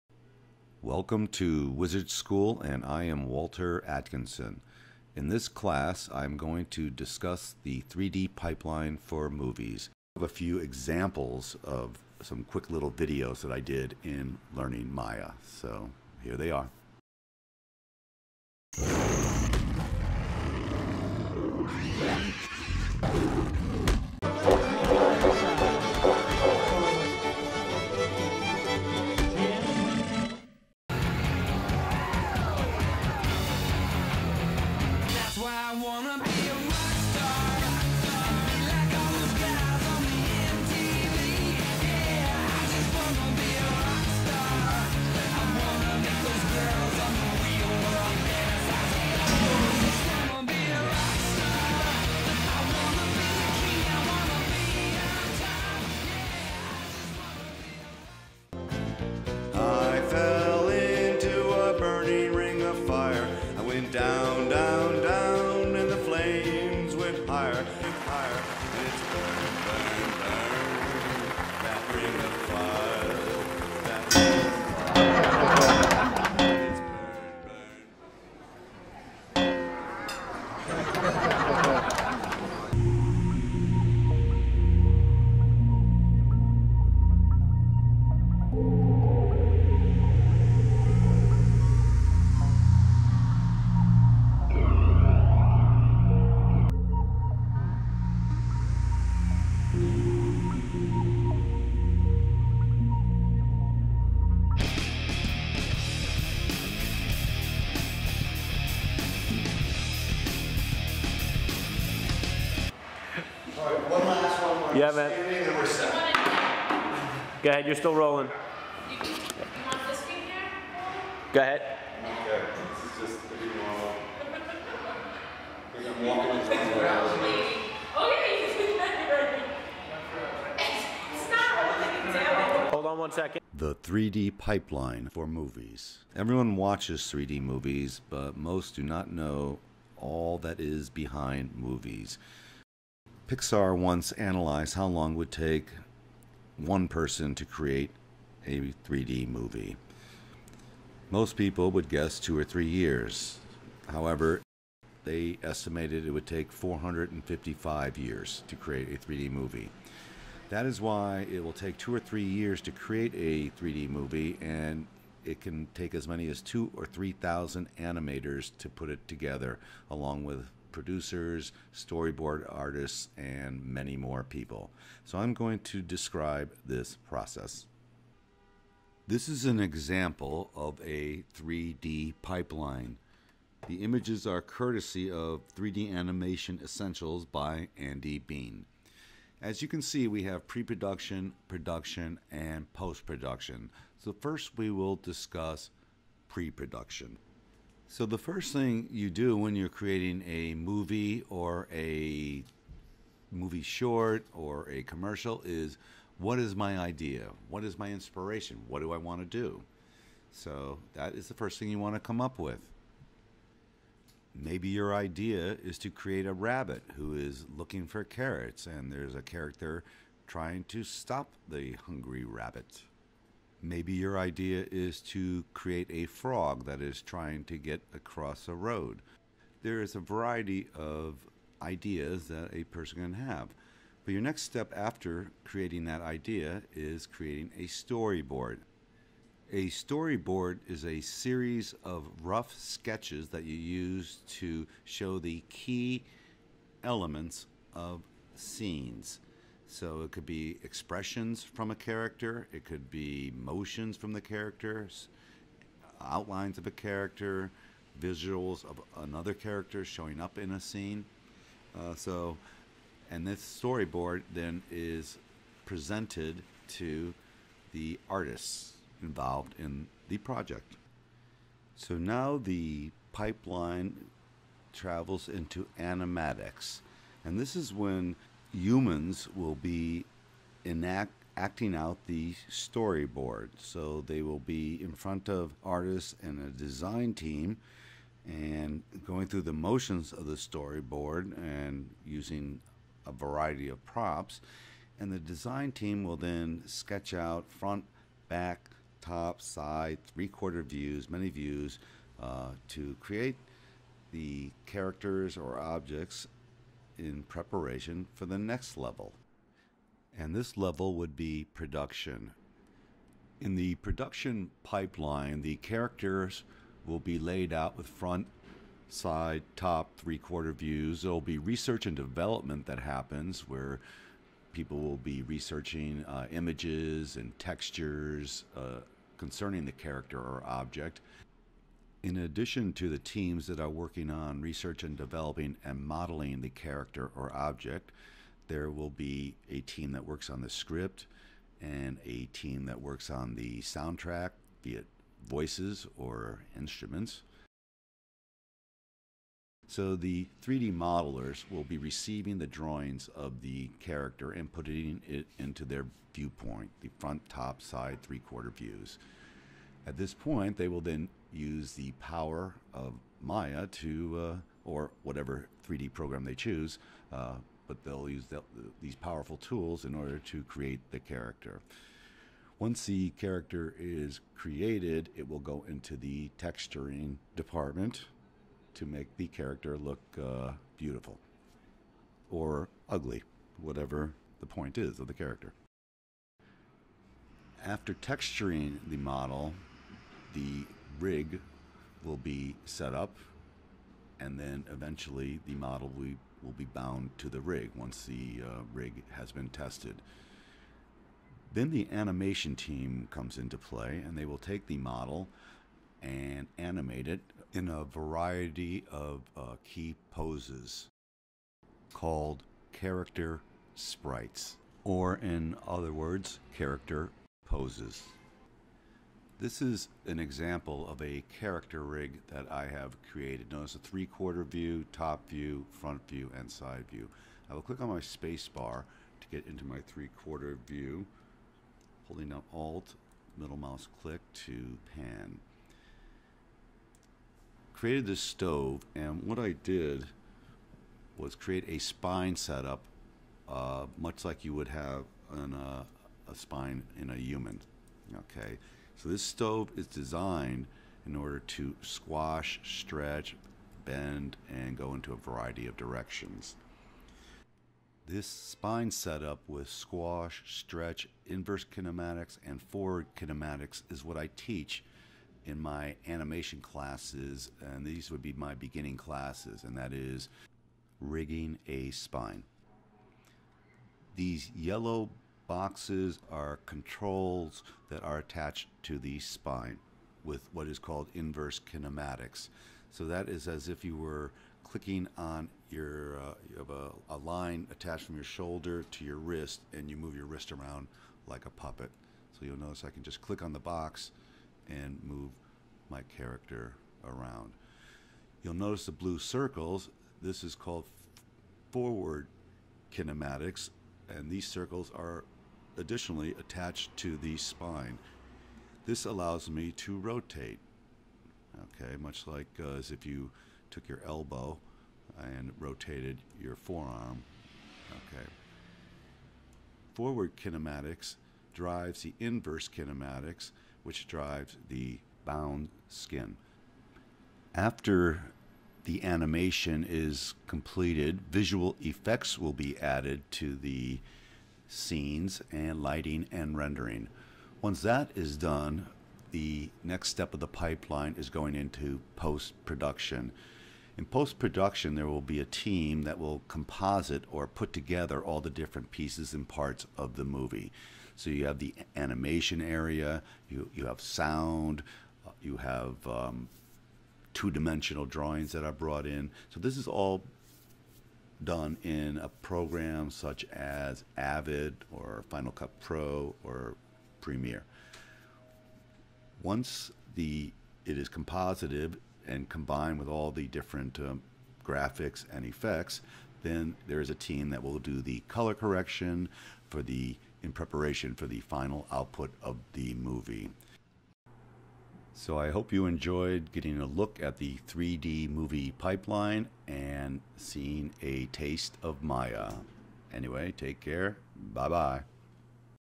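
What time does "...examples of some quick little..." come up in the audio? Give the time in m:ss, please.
0:10.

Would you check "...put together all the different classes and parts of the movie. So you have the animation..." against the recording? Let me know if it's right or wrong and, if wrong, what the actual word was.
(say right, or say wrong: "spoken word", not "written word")
wrong: "pieces", not "classes".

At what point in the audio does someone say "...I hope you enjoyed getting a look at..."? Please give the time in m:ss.
9:45.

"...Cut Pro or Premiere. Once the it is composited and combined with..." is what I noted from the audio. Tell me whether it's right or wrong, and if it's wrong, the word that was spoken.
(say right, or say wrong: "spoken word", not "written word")
right.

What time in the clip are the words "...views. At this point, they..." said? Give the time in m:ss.
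5:58.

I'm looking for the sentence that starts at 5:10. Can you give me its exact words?
And this level would be production.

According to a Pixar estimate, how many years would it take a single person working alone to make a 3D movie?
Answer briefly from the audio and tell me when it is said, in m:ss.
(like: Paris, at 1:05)
455, at 2:36.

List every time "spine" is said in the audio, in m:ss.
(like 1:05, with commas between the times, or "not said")
7:21, 7:26, 7:38, 7:51, 7:59, 8:27.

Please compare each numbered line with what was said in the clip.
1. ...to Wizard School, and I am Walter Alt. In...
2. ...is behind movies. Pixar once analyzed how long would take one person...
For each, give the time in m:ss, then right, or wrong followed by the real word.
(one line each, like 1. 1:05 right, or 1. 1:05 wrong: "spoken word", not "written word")
1. 0:01 wrong: "Atkinson", not "Alt"
2. 2:20 right.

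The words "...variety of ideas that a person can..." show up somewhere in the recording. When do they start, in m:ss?
3:49.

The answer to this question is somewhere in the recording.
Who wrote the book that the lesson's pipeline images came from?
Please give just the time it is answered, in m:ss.
3:07.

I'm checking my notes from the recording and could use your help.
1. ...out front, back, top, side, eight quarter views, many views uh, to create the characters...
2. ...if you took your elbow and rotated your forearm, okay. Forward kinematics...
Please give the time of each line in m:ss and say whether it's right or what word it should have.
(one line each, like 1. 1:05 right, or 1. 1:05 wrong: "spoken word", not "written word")
1. 4:57 wrong: "three", not "eight"
2. 8:32 right.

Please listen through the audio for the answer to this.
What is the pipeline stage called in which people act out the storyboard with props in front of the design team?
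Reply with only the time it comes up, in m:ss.
4:35.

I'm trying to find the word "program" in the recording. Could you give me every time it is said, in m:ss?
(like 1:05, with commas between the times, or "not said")
6:05, 9:22.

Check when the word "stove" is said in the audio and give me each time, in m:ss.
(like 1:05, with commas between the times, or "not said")
7:18, 7:29.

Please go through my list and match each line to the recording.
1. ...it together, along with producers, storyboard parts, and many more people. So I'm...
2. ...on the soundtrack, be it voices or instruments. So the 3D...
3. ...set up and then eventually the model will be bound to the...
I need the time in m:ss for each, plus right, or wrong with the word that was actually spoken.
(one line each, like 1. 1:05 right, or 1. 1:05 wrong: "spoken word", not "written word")
1. 2:48 wrong: "artists", not "parts"
2. 5:43 right
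3. 6:32 right.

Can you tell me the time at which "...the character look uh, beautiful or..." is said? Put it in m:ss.
6:19.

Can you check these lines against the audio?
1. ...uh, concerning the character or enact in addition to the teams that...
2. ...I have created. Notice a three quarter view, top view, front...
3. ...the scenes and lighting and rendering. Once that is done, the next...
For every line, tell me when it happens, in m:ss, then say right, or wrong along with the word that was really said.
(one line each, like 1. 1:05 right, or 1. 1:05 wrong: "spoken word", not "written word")
1. 5:28 wrong: "object", not "enact"
2. 7:02 right
3. 8:53 right.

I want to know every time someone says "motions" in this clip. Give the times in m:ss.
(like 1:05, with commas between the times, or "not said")
4:13, 4:49.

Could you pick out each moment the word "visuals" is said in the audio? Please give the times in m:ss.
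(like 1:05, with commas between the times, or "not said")
4:18, 8:51.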